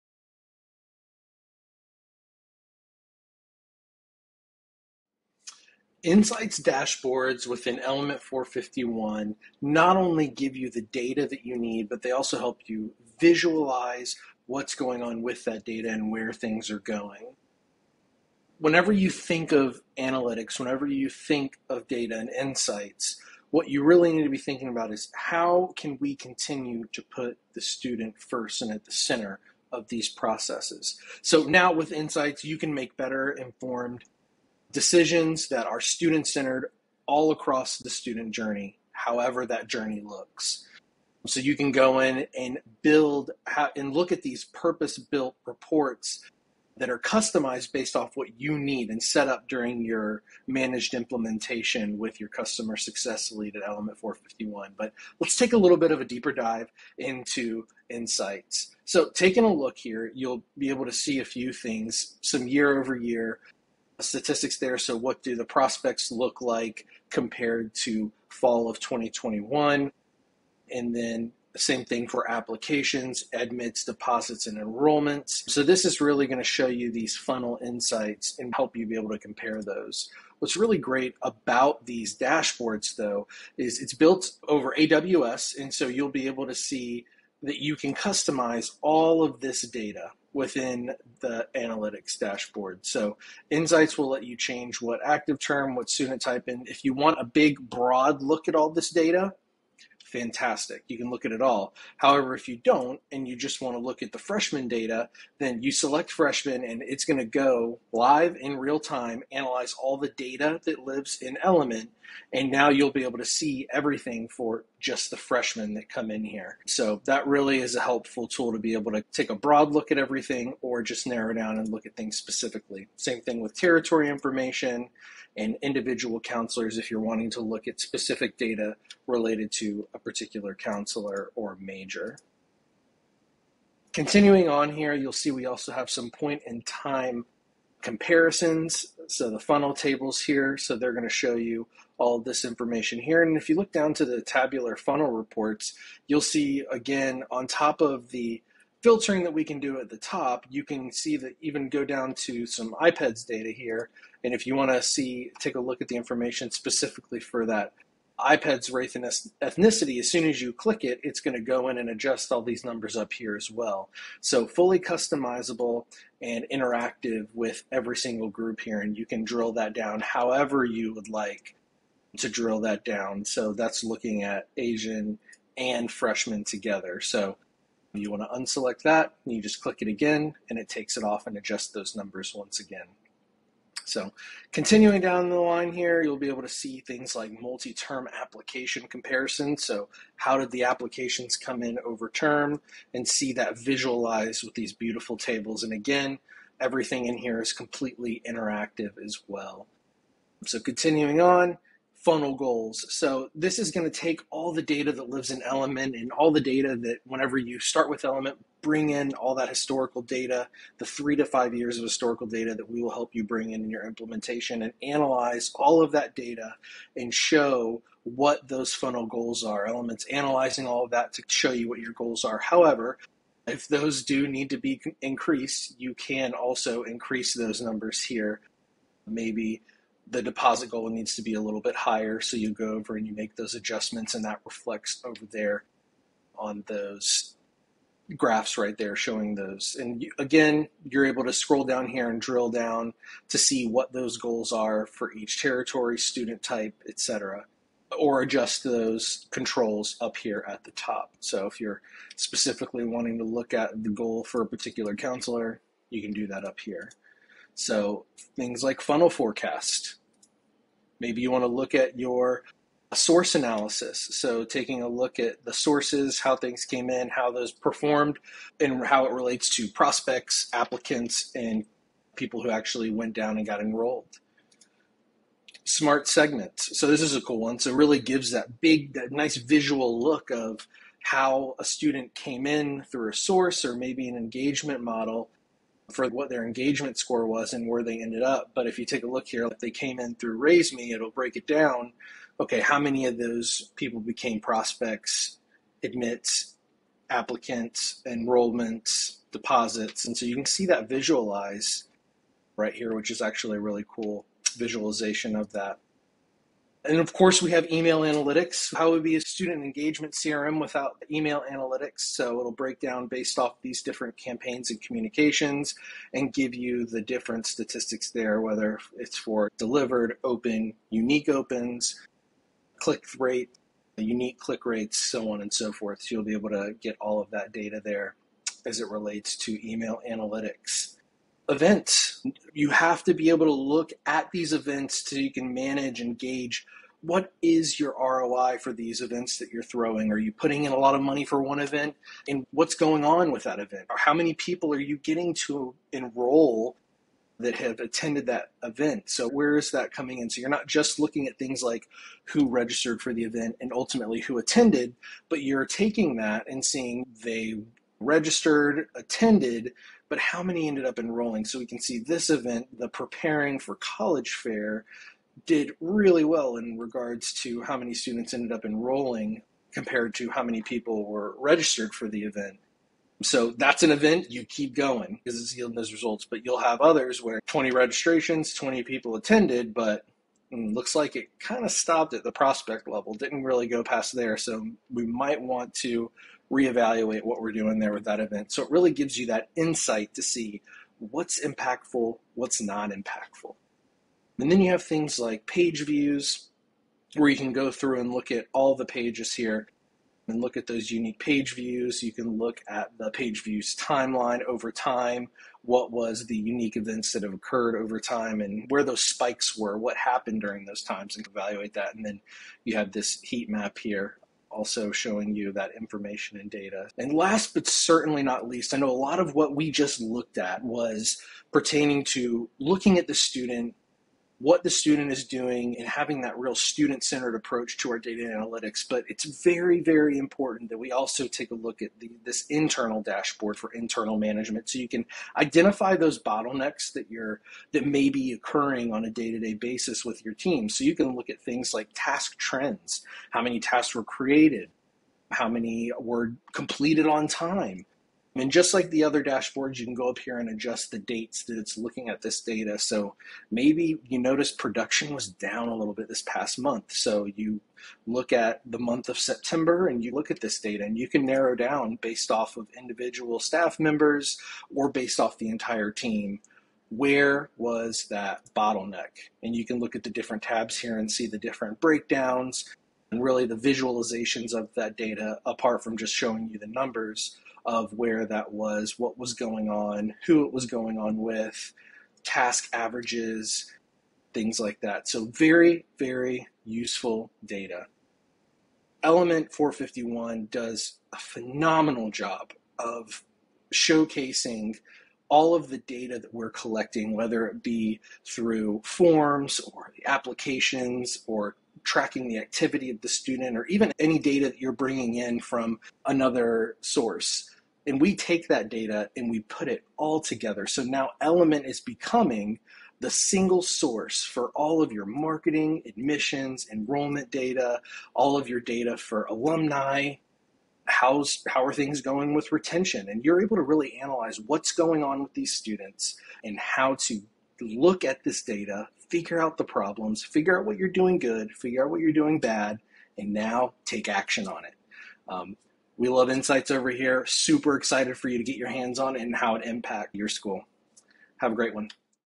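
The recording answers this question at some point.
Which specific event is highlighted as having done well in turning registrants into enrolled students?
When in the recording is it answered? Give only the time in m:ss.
6:02.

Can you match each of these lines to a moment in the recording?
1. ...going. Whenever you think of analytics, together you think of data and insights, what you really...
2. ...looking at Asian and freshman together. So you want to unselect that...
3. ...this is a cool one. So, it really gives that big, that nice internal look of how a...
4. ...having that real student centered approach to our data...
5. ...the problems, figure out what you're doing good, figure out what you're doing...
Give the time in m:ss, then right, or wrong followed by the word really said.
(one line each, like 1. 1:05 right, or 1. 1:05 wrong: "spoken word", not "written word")
1. 0:16 wrong: "whenever", not "together"
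2. 2:53 right
3. 4:36 wrong: "visual", not "internal"
4. 7:05 right
5. 8:49 right.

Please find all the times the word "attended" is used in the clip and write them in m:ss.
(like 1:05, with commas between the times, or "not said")
5:47, 5:54, 5:58, 6:19.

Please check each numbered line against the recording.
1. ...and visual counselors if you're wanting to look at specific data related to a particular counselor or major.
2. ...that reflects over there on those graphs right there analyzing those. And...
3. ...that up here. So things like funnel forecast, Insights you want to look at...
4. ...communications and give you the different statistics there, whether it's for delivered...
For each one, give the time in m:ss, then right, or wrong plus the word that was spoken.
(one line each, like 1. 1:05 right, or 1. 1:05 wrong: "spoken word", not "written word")
1. 2:05 wrong: "individual", not "visual"
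2. 3:54 wrong: "showing", not "analyzing"
3. 4:16 wrong: "Maybe", not "Insights"
4. 5:14 right.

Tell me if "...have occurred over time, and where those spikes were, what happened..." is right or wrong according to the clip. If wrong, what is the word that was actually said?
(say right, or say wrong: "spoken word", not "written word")
right.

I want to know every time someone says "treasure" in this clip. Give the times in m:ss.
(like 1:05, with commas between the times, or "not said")
not said.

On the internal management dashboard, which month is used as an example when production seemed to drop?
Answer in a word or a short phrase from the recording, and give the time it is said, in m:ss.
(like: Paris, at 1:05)
September, at 7:39.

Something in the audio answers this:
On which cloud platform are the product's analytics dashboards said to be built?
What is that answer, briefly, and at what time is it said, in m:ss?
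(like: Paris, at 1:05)
AWS, at 1:24.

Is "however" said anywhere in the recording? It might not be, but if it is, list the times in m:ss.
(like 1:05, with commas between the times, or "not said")
0:38, 1:41, 2:50, 3:42.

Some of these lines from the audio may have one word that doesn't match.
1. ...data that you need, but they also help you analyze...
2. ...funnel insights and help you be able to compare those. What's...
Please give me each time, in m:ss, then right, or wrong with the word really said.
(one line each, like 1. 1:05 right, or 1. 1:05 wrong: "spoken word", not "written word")
1. 0:10 wrong: "visualize", not "analyze"
2. 1:17 right.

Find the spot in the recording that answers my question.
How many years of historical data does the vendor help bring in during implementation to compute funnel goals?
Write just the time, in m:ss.
3:30.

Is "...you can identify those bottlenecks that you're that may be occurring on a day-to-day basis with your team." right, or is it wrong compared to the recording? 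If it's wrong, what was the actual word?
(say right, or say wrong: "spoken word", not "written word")
right.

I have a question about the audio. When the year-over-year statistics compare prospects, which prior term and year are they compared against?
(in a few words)
Fall 2021.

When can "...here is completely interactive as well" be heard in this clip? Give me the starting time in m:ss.
3:17.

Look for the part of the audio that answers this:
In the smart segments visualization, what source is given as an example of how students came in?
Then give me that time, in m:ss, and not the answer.
4:50.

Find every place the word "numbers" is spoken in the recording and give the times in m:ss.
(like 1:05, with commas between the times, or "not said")
2:42, 3:01, 3:47, 7:56.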